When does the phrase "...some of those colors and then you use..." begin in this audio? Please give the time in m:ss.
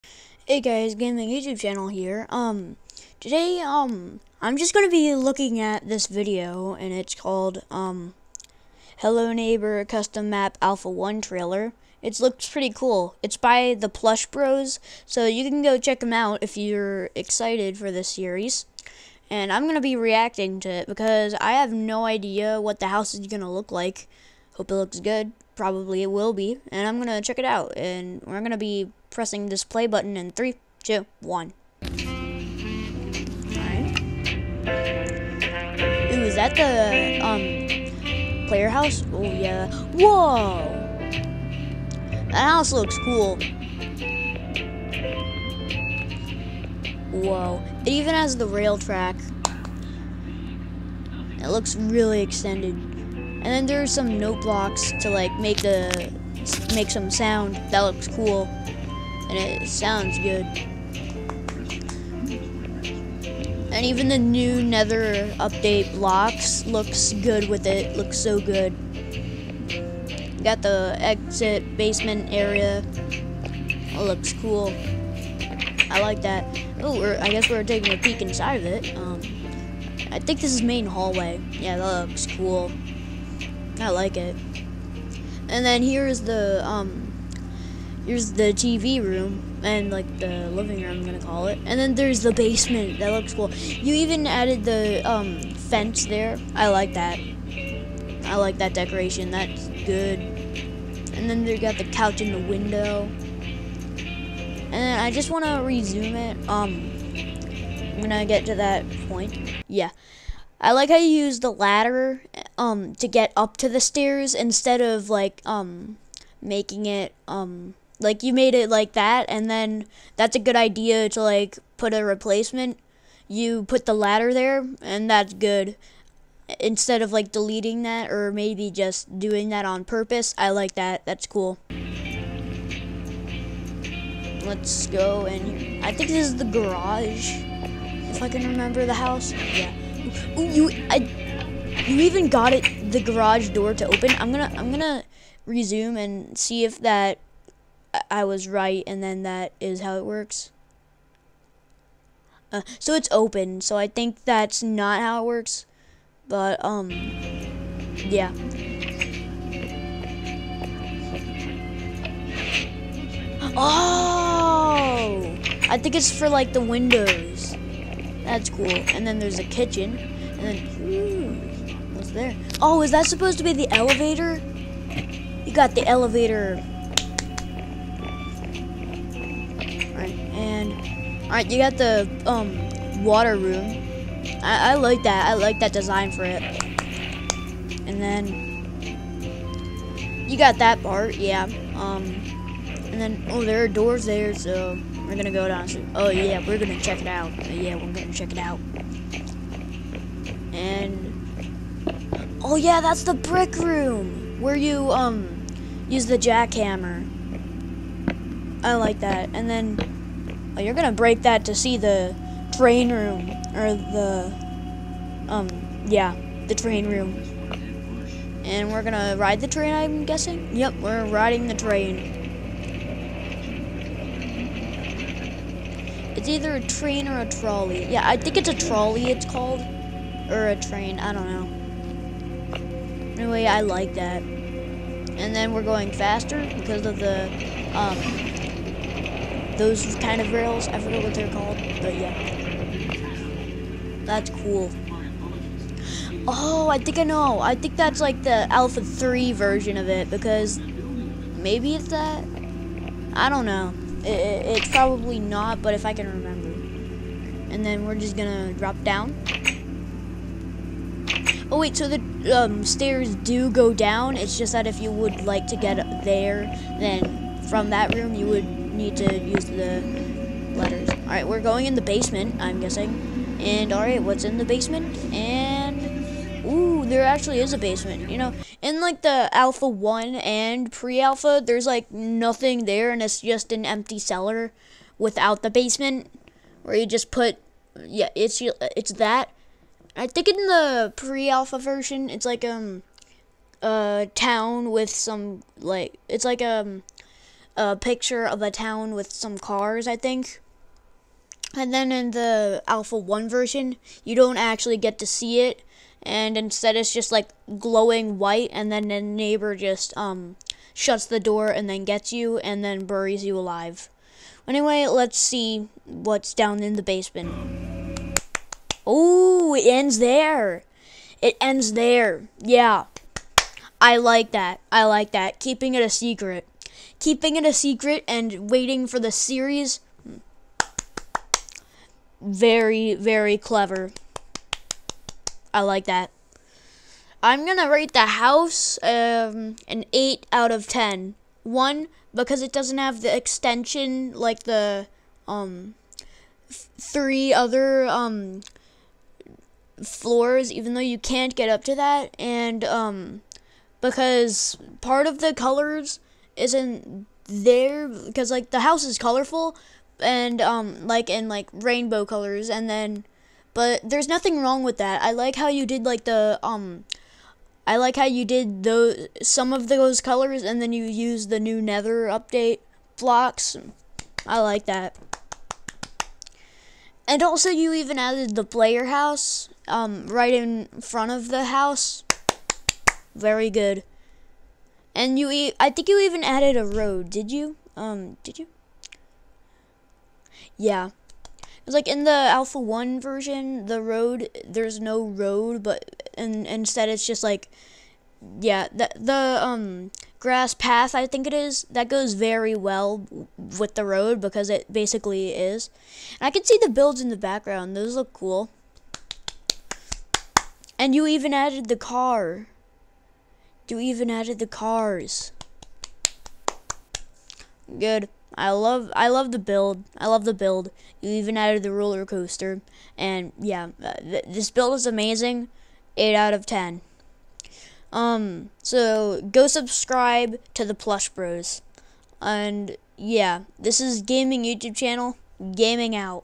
6:09.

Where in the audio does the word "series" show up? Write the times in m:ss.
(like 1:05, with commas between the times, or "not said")
0:18, 5:29.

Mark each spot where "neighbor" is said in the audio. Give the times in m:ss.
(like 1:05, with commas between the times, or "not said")
0:09, 5:09.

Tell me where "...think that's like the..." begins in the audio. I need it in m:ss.
4:07.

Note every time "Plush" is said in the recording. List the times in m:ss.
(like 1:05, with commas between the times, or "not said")
0:13, 7:10.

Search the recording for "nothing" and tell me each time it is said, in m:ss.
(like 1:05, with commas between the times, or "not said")
4:41, 6:04.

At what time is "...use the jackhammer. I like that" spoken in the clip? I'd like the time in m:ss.
3:25.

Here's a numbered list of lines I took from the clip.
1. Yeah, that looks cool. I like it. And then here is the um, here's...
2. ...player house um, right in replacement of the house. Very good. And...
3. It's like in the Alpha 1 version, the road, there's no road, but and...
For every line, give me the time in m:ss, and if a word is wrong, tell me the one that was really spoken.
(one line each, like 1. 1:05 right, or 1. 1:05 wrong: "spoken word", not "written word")
1. 1:21 right
2. 6:18 wrong: "front", not "replacement"
3. 6:31 right.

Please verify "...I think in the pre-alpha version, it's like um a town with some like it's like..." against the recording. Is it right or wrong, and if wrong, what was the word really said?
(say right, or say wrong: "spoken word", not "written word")
right.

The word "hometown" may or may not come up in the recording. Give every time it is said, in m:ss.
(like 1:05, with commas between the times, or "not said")
not said.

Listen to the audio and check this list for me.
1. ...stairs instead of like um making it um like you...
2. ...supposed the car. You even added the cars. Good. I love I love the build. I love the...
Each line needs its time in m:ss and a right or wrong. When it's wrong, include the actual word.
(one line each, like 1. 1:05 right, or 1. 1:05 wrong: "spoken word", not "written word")
1. 1:53 right
2. 6:51 wrong: "added", not "supposed".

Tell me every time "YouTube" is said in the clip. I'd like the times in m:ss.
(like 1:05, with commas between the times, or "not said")
0:01, 7:14.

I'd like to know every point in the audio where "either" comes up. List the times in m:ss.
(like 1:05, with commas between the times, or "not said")
3:46.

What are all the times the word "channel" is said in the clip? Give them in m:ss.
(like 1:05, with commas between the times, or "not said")
0:01, 7:14.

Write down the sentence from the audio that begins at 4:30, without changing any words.
All right, we're going in the basement, I'm guessing.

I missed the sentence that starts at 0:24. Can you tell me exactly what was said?
Hope it looks good probably it will be, and I'm gonna check it out.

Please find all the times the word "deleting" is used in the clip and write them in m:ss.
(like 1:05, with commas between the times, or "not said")
2:07.